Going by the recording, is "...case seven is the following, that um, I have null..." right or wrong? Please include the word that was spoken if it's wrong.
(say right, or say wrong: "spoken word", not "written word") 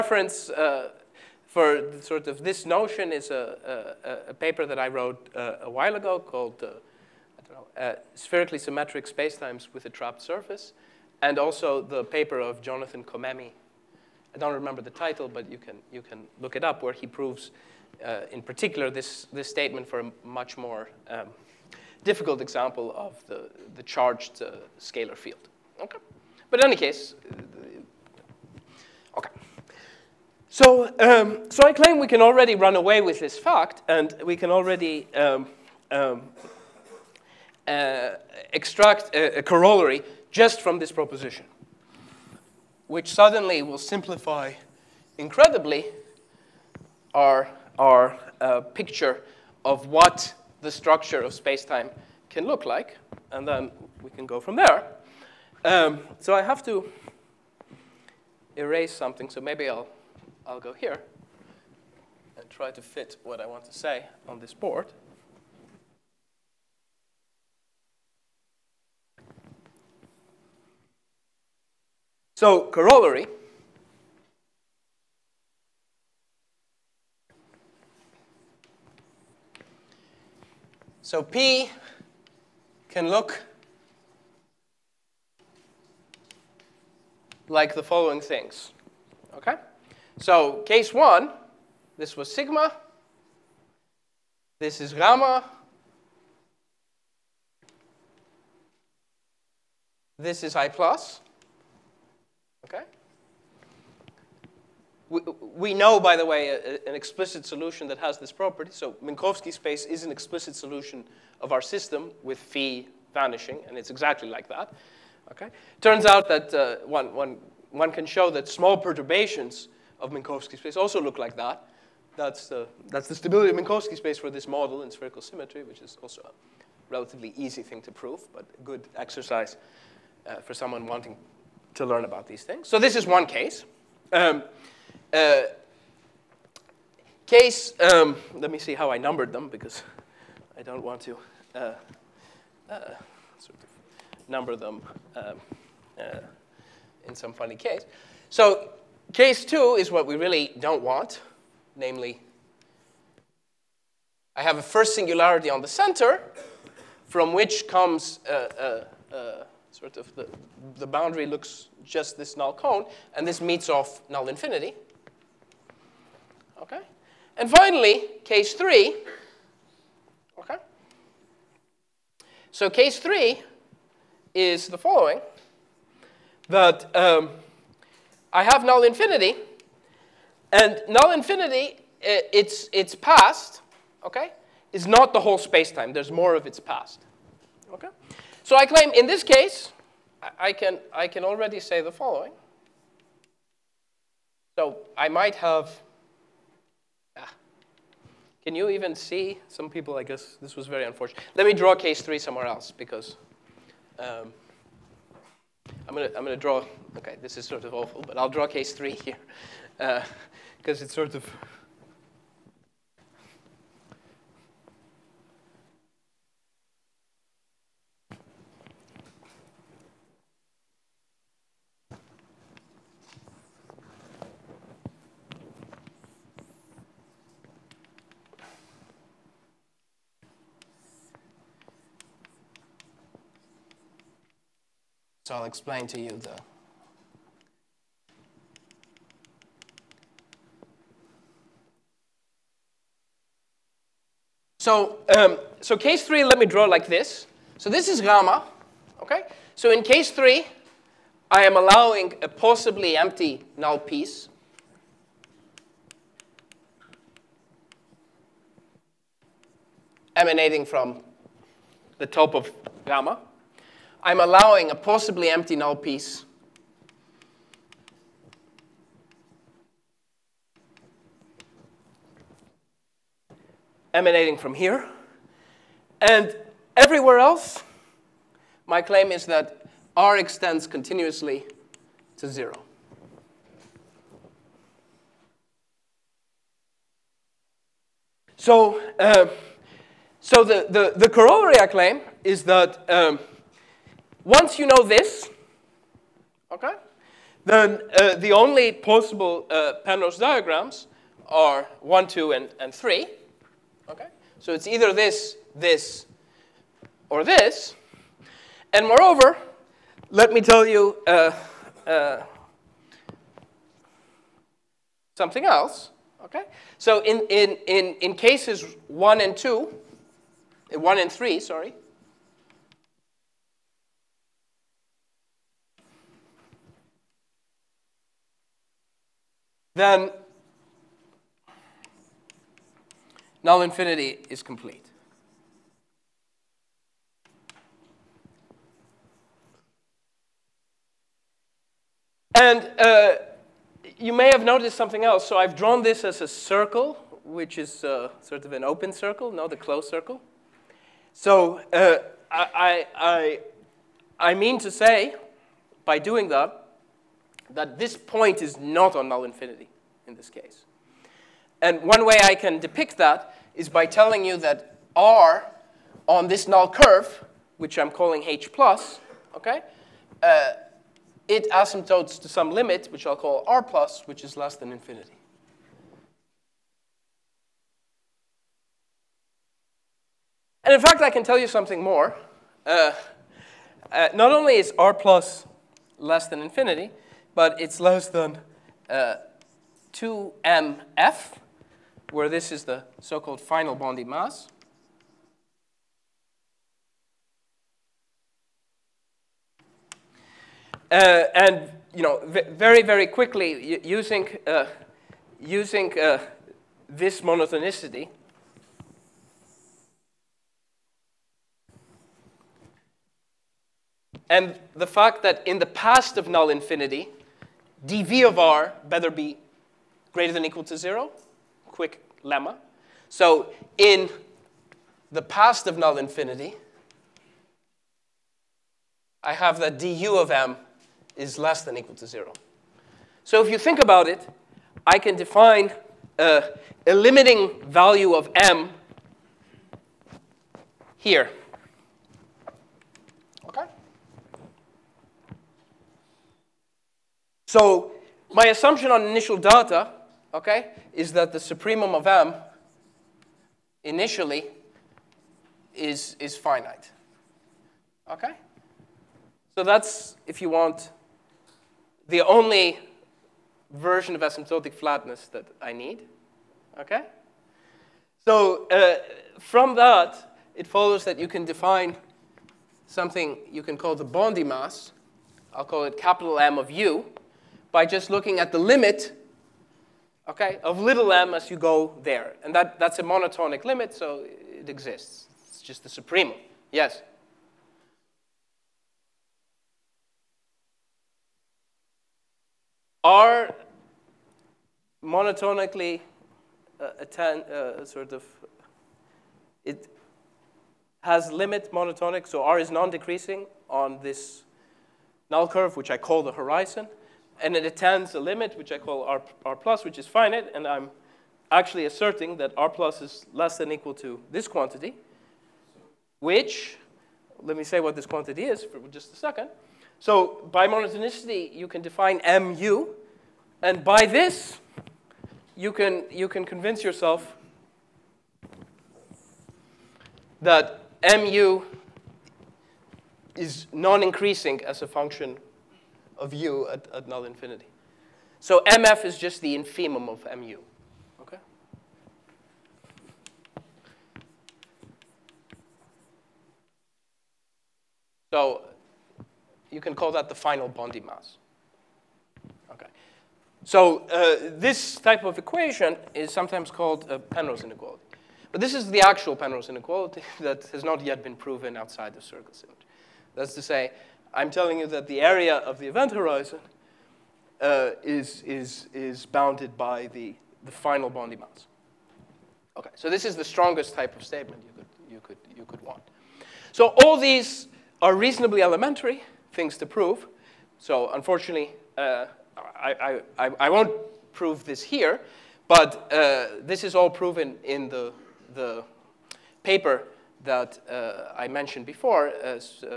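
wrong: "three", not "seven".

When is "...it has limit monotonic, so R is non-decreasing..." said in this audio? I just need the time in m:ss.
8:19.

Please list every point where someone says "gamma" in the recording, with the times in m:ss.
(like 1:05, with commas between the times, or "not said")
1:34, 4:07, 4:22.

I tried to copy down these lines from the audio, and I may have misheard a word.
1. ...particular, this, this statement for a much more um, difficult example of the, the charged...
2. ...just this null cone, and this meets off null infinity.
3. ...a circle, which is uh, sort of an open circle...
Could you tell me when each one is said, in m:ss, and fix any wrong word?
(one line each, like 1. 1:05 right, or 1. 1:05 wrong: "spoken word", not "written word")
1. 0:18 right
2. 2:41 right
3. 5:46 right.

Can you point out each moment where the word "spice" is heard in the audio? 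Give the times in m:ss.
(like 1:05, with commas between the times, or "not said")
not said.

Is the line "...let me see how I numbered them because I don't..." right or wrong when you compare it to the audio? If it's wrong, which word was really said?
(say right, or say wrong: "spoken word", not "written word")
right.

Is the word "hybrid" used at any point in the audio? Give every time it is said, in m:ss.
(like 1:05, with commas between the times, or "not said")
not said.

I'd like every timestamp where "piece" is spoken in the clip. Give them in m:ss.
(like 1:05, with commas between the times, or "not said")
4:13, 4:25.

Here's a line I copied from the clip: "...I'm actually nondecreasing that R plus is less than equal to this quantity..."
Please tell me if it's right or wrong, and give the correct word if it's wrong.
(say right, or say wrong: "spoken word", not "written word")
wrong: "asserting", not "nondecreasing".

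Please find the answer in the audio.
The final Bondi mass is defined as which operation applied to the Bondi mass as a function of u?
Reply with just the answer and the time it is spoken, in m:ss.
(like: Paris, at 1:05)
infimum, at 8:59.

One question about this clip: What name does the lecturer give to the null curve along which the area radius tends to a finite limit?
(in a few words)
H plus.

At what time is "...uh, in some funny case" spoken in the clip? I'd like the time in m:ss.
2:25.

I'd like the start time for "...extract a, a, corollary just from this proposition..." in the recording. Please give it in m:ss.
0:38.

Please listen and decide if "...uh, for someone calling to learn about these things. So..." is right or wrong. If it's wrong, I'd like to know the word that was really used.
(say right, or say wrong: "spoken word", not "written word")
wrong: "wanting", not "calling".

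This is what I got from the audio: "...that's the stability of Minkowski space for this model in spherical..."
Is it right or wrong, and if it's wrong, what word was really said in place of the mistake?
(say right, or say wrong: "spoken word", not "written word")
right.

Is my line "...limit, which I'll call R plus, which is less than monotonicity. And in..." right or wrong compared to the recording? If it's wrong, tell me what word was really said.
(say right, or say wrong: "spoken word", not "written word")
wrong: "infinity", not "monotonicity".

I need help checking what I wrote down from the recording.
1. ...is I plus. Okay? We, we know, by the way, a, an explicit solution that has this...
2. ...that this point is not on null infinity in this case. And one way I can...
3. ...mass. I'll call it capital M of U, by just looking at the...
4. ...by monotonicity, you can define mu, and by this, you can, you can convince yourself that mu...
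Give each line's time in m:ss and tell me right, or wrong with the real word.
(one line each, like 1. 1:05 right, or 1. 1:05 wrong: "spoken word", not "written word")
1. 1:40 right
2. 5:57 right
3. 7:54 right
4. 8:40 right.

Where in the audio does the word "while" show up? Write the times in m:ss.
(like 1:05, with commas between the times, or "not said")
0:05.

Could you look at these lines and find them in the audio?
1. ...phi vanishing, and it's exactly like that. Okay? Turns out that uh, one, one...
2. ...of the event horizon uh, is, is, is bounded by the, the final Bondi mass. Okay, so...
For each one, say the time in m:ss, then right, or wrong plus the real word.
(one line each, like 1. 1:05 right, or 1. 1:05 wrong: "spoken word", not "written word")
1. 1:52 right
2. 9:25 right.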